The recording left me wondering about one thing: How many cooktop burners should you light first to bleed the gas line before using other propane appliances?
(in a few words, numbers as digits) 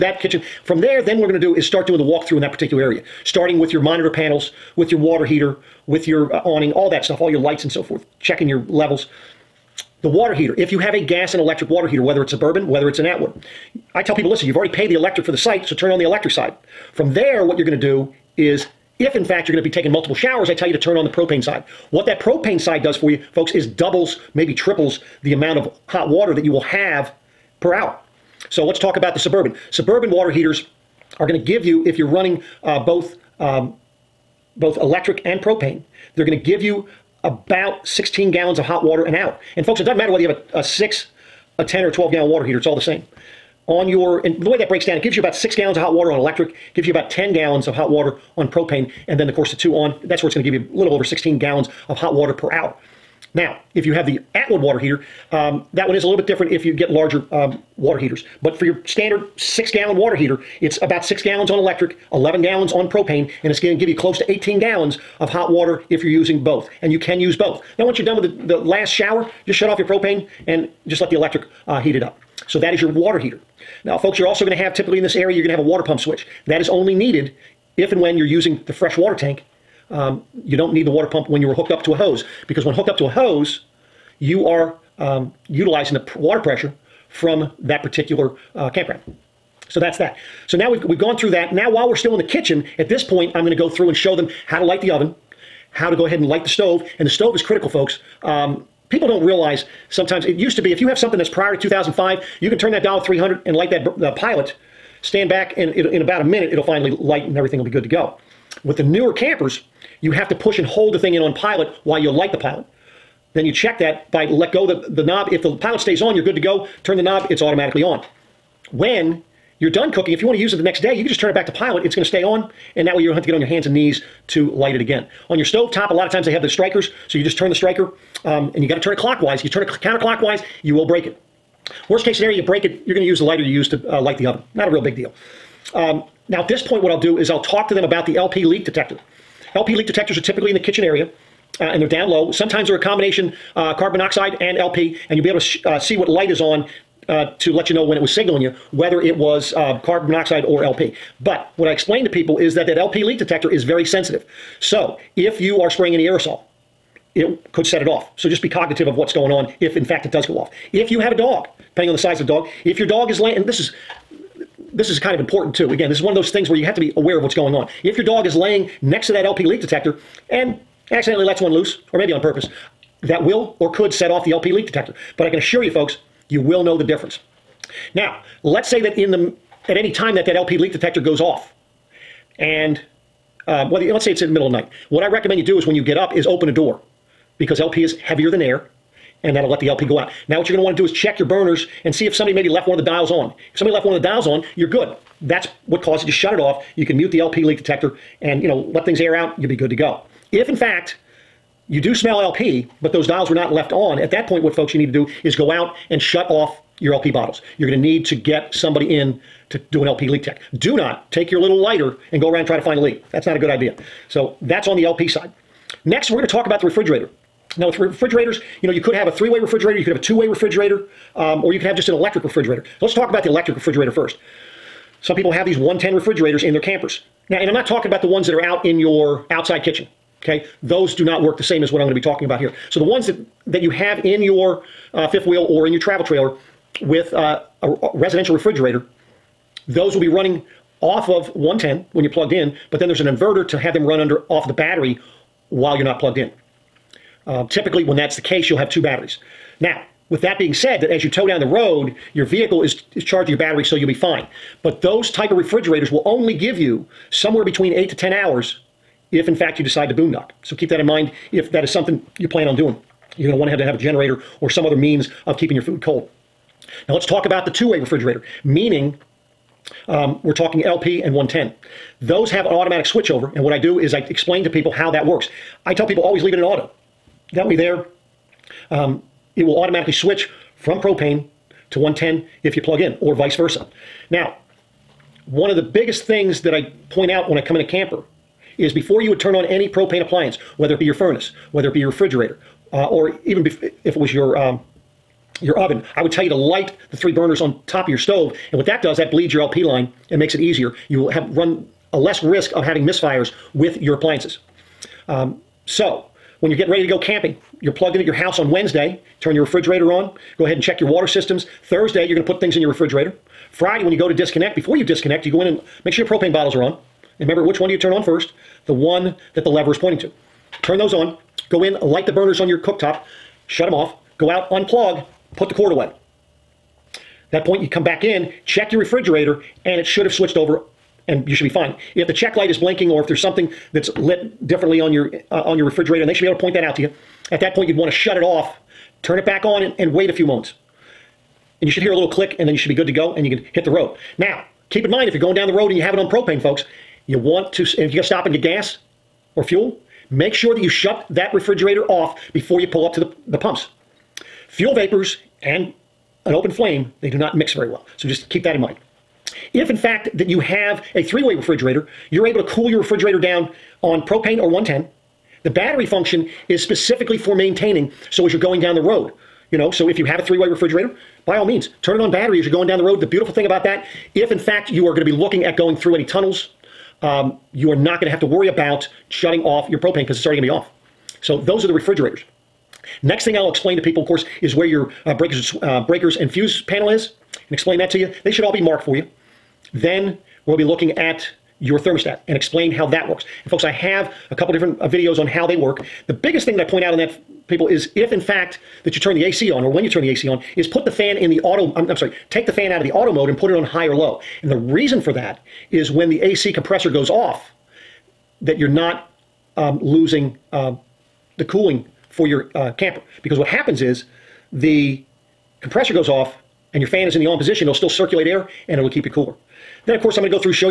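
Three.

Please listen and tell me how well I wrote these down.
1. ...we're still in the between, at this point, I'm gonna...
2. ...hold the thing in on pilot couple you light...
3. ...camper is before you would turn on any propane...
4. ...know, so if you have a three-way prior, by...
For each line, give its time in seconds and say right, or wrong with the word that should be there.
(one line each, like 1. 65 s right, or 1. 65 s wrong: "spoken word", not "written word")
1. 91 s wrong: "kitchen", not "between"
2. 110 s wrong: "while", not "couple"
3. 287 s right
4. 369 s wrong: "refrigerator", not "prior".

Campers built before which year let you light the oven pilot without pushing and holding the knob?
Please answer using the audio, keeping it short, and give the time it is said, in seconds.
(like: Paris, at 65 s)
2005, at 101 s.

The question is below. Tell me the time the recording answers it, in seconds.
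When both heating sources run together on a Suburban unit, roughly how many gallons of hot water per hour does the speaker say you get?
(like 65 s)
37 s.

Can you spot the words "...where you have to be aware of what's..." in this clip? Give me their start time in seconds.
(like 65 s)
166 s.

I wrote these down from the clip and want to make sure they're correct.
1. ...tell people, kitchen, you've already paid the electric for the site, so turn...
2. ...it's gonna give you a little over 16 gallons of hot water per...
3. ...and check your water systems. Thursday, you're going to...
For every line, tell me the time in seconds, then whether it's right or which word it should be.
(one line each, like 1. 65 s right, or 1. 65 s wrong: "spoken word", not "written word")
1. 14 s wrong: "listen", not "kitchen"
2. 50 s right
3. 310 s right.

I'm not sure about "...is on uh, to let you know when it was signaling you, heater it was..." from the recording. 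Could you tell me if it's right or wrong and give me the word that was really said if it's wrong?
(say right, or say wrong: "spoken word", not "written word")
wrong: "whether", not "heater".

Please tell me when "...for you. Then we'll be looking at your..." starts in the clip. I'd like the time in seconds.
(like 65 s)
388 s.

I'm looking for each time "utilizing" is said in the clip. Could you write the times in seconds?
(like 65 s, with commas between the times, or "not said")
85 s.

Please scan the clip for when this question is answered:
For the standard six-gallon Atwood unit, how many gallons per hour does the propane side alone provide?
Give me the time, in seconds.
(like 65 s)
62 s.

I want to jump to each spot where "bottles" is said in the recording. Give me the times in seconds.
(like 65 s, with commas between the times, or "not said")
207 s, 316 s.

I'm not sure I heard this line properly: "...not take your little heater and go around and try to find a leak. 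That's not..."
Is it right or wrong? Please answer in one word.
wrong.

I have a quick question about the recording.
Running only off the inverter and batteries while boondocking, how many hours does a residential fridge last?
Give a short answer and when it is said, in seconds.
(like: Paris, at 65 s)
8 to 10 hours, at 257 s.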